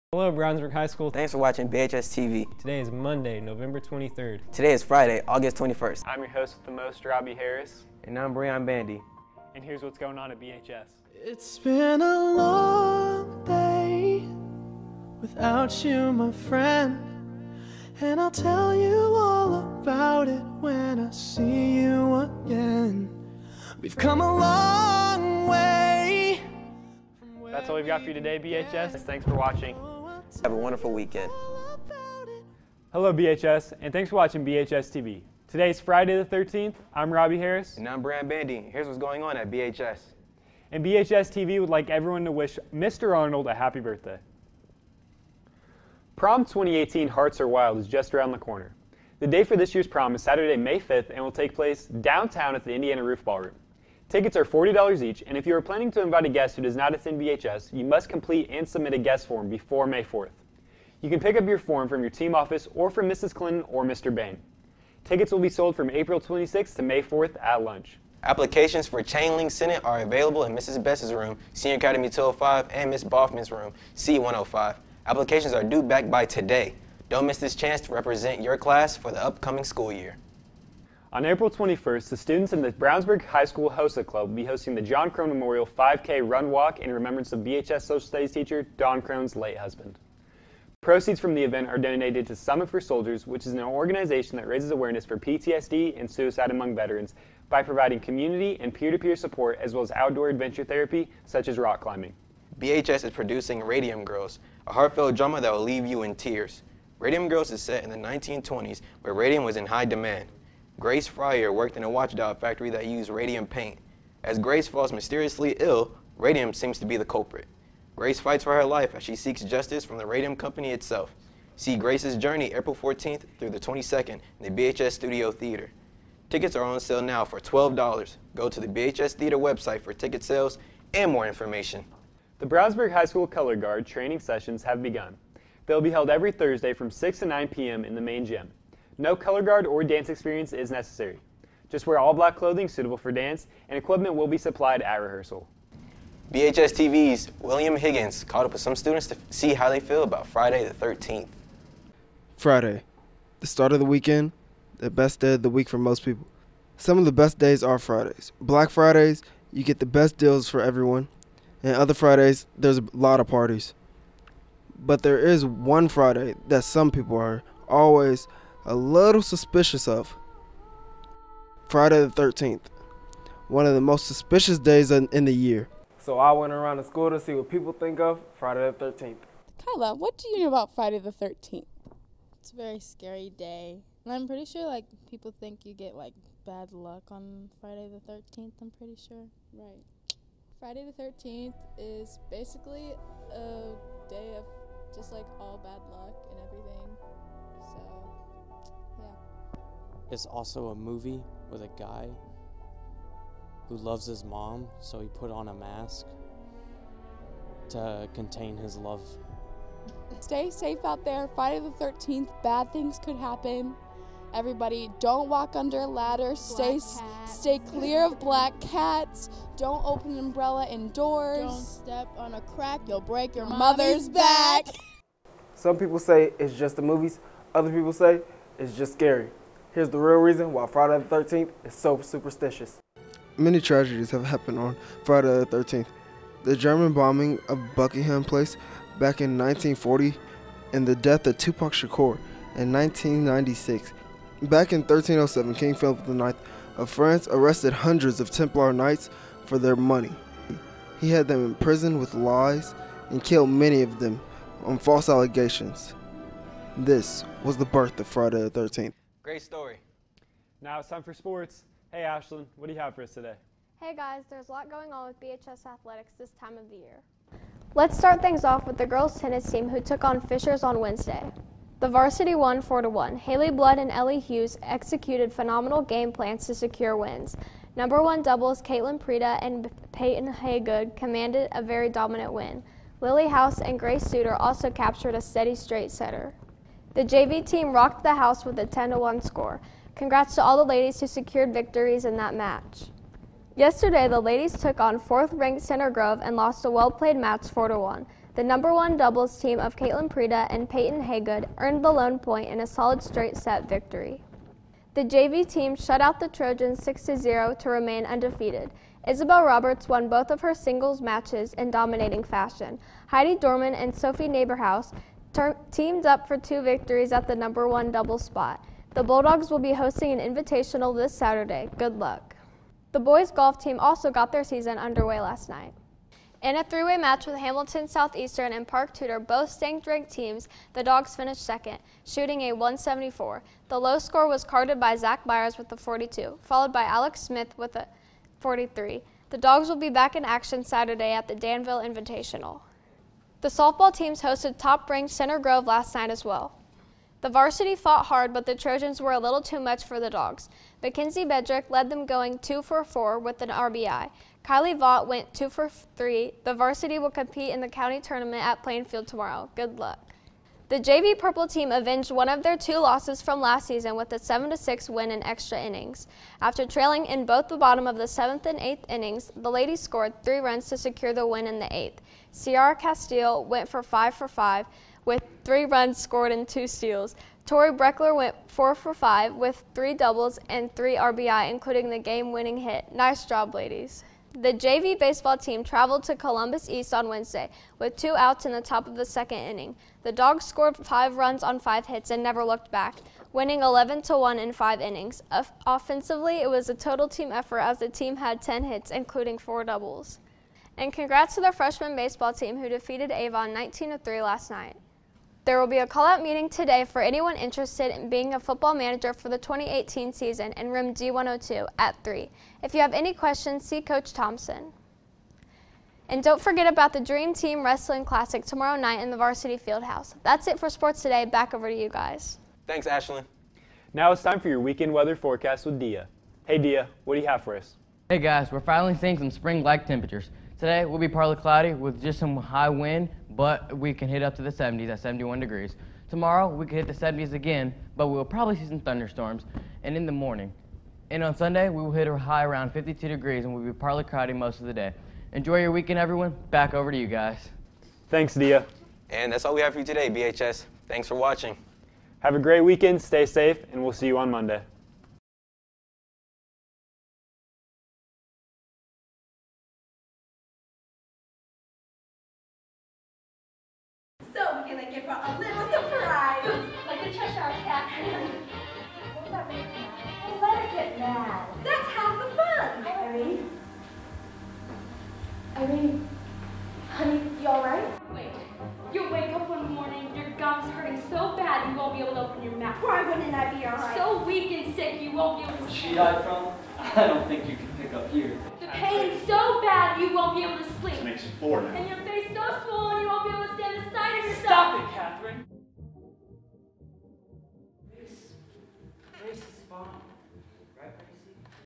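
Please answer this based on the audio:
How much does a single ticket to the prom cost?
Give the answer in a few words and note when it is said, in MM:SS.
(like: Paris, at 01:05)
$40, at 00:54.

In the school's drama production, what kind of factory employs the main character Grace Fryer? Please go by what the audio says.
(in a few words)
watch dial factory.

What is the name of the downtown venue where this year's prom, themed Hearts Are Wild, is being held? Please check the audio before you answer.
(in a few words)
Indiana Roof Ballroom.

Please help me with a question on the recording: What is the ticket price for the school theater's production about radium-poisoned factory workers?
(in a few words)
$12.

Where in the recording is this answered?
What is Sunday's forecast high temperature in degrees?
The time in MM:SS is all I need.
07:22.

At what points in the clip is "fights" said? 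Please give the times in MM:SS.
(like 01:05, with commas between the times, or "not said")
01:58.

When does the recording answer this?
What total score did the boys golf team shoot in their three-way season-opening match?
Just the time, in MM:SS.
05:32.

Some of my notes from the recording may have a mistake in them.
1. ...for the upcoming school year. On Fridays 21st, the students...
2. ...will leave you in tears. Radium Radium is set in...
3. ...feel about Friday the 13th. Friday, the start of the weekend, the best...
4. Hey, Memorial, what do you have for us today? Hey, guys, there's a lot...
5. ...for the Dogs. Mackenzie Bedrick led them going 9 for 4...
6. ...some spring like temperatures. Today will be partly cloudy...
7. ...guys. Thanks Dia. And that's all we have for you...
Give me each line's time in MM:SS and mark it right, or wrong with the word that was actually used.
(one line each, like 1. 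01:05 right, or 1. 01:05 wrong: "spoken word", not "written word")
1. 01:18 wrong: "April", not "Fridays"
2. 01:45 wrong: "Girls", not "Radium"
3. 02:29 right
4. 04:21 wrong: "Ashlyn", not "Memorial"
5. 05:49 wrong: "2", not "9"
6. 07:09 right
7. 07:27 right.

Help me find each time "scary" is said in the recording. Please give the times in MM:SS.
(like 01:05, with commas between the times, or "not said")
03:02, 03:48.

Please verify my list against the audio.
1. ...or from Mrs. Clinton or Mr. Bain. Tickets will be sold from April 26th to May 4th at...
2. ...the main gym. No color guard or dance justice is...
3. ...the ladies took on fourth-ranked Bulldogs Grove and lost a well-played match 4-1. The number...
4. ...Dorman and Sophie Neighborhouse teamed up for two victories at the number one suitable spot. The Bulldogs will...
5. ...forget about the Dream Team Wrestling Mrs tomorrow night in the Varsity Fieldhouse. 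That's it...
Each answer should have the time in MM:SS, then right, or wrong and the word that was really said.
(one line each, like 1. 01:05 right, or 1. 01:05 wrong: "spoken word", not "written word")
1. 01:02 right
2. 02:17 wrong: "experience", not "justice"
3. 04:54 wrong: "Center", not "Bulldogs"
4. 05:13 wrong: "double", not "suitable"
5. 06:56 wrong: "Classic", not "Mrs".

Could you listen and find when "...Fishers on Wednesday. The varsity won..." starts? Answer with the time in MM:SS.
04:30.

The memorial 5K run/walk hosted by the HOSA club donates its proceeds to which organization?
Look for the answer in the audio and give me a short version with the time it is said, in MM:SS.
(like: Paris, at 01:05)
Summit for Soldiers, at 01:32.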